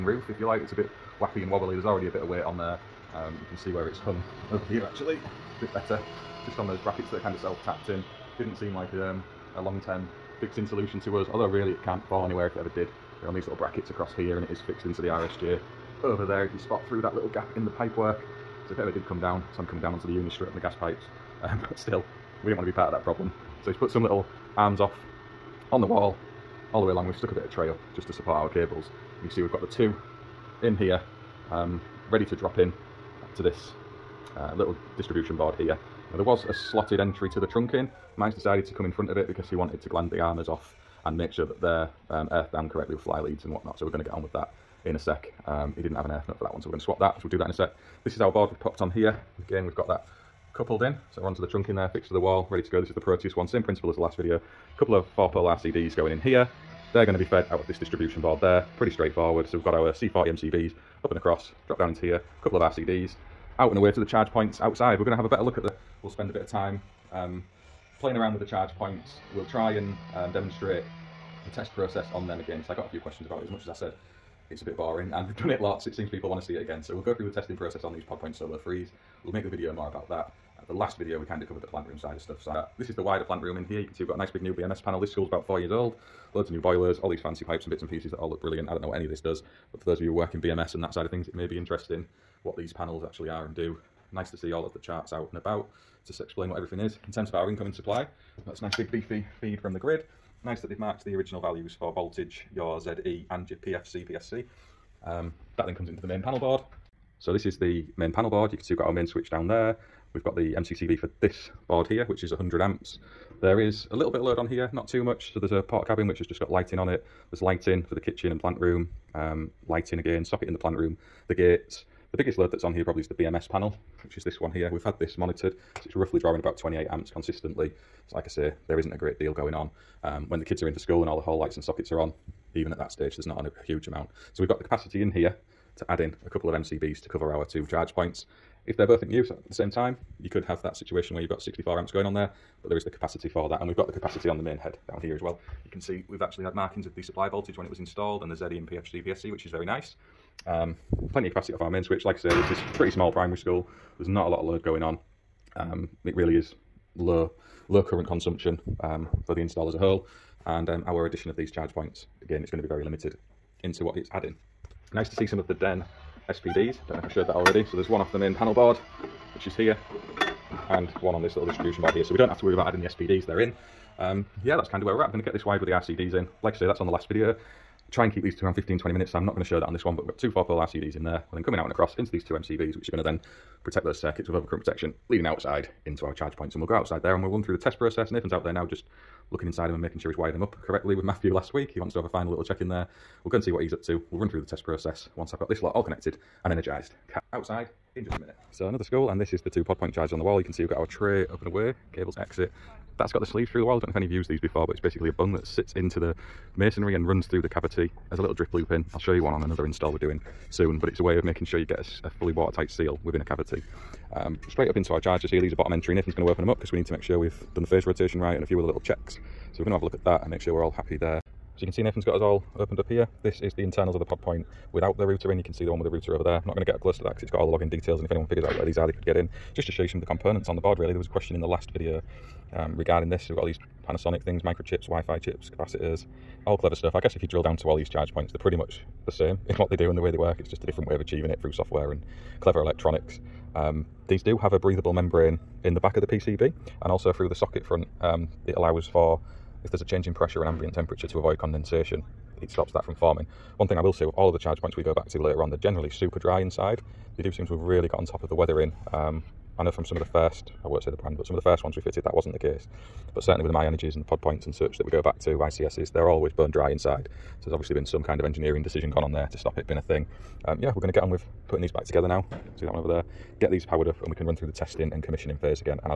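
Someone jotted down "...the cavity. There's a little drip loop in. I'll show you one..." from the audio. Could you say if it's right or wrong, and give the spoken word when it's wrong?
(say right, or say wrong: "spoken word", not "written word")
right.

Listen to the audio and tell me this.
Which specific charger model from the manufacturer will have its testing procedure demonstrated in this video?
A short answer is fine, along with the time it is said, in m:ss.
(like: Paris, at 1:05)
PodPoint Solo 3, at 1:18.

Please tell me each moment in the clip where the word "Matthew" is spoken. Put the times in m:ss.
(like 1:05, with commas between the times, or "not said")
3:11.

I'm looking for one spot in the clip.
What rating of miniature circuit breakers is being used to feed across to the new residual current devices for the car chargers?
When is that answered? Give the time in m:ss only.
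0:59.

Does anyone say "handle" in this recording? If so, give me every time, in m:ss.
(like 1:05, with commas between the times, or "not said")
not said.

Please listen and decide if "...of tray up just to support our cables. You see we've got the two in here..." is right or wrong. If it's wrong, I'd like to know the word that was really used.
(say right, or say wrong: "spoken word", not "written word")
right.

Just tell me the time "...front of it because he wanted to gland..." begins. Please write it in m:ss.
0:38.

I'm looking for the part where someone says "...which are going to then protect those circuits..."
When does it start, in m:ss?
3:02.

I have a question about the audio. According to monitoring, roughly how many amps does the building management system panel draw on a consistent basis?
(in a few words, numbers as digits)
28 amps.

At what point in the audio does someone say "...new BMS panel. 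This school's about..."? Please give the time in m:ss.
1:24.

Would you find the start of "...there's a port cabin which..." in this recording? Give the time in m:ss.
1:55.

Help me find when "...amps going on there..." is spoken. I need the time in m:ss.
2:21.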